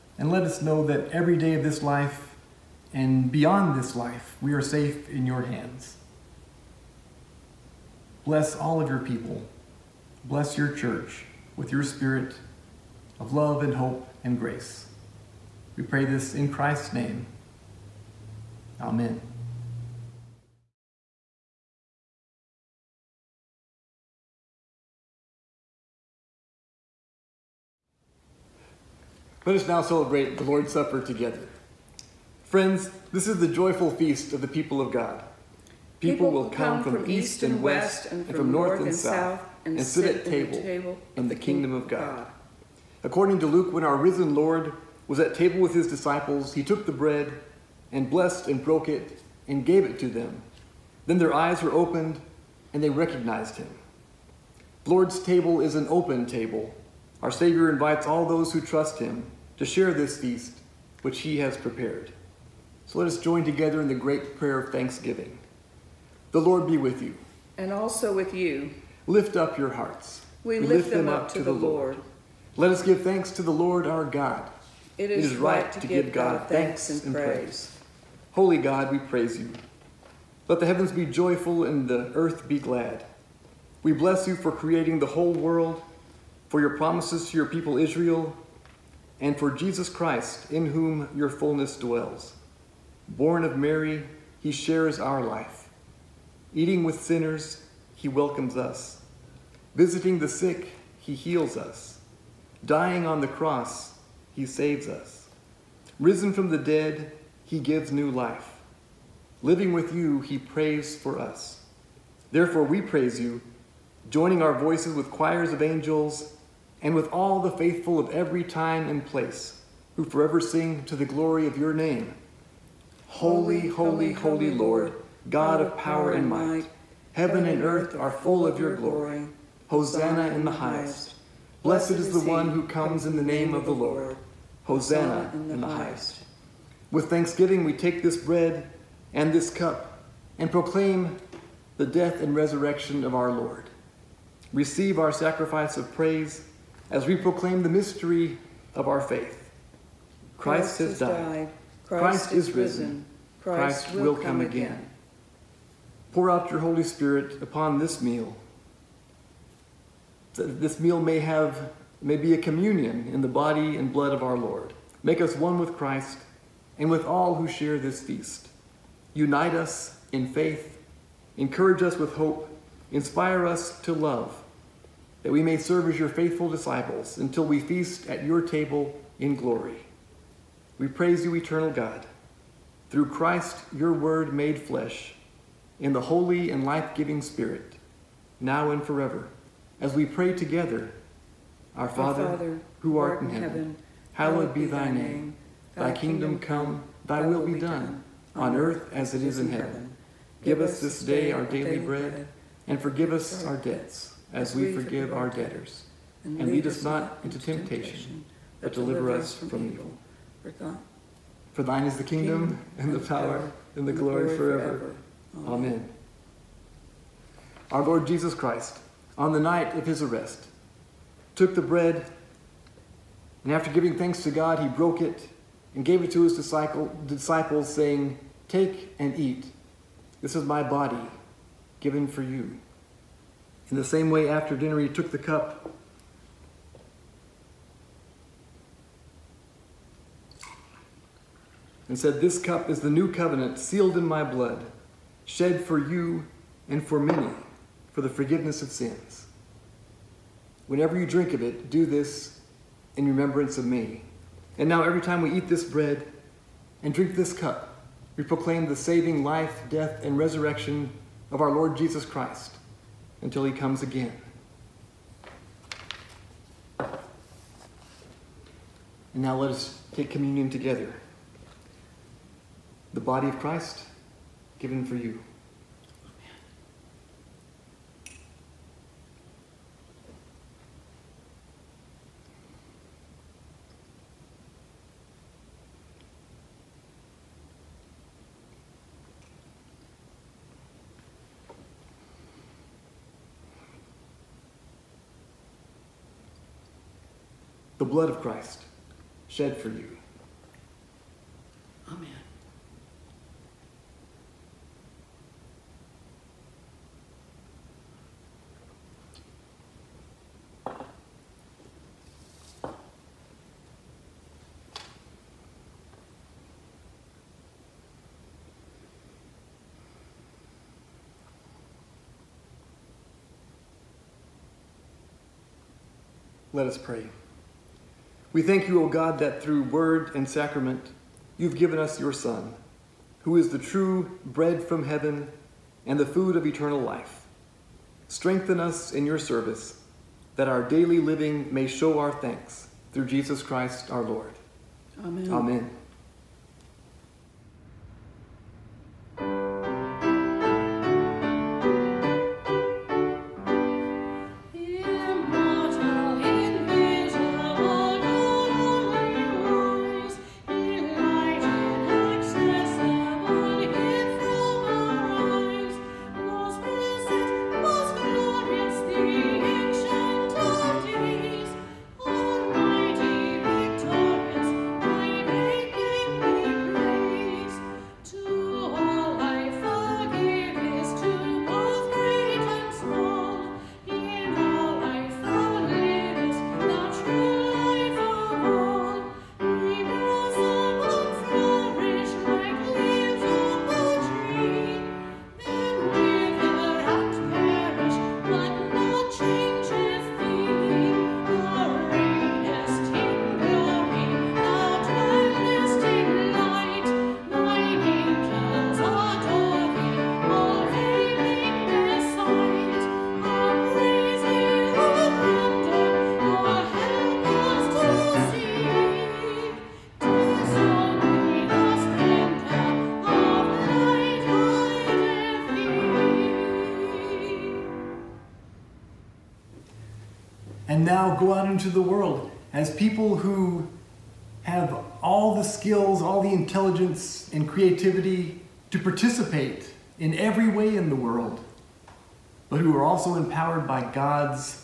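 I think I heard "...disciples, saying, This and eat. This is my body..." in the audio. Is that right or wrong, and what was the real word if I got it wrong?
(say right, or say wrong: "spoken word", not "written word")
wrong: "Take", not "This".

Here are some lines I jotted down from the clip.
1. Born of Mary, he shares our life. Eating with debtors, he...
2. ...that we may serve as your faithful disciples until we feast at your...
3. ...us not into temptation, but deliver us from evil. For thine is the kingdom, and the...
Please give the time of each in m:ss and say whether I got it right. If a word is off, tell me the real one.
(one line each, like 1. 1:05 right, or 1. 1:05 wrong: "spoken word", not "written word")
1. 1:33 wrong: "sinners", not "debtors"
2. 2:55 right
3. 3:26 right.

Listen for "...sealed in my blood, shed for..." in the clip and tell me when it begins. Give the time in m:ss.
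4:03.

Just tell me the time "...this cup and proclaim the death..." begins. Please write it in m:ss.
2:19.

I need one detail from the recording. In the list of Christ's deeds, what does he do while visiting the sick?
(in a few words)
heals us.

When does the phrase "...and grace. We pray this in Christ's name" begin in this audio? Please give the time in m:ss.
0:14.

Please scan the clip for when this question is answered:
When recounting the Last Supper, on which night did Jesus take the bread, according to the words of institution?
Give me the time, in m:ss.
3:39.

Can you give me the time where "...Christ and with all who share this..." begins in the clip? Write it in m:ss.
2:45.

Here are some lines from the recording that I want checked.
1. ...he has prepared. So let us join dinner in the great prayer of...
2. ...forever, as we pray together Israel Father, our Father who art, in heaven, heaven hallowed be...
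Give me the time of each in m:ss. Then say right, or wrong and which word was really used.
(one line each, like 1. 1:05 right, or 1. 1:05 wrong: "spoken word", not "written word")
1. 1:01 wrong: "together", not "dinner"
2. 3:08 wrong: "Our", not "Israel".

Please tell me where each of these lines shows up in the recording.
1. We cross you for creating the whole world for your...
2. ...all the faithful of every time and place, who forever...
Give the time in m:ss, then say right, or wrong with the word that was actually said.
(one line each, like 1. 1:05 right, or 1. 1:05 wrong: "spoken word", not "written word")
1. 1:23 wrong: "bless", not "cross"
2. 1:57 right.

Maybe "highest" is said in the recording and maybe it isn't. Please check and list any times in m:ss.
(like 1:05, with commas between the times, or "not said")
2:10, 2:15.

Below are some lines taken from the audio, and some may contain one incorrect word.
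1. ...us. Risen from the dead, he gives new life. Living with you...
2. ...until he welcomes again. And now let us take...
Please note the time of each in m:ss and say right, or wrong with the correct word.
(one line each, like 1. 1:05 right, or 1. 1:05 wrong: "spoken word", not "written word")
1. 1:44 right
2. 4:23 wrong: "comes", not "welcomes".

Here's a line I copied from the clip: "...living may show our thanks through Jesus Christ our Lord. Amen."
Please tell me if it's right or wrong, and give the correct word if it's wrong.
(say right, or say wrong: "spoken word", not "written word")
right.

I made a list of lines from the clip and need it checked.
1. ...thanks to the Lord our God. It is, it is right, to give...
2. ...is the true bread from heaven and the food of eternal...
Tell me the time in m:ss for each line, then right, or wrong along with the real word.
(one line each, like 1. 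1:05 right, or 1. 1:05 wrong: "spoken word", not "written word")
1. 1:13 right
2. 5:33 right.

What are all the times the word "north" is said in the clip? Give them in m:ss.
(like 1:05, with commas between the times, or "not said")
0:38.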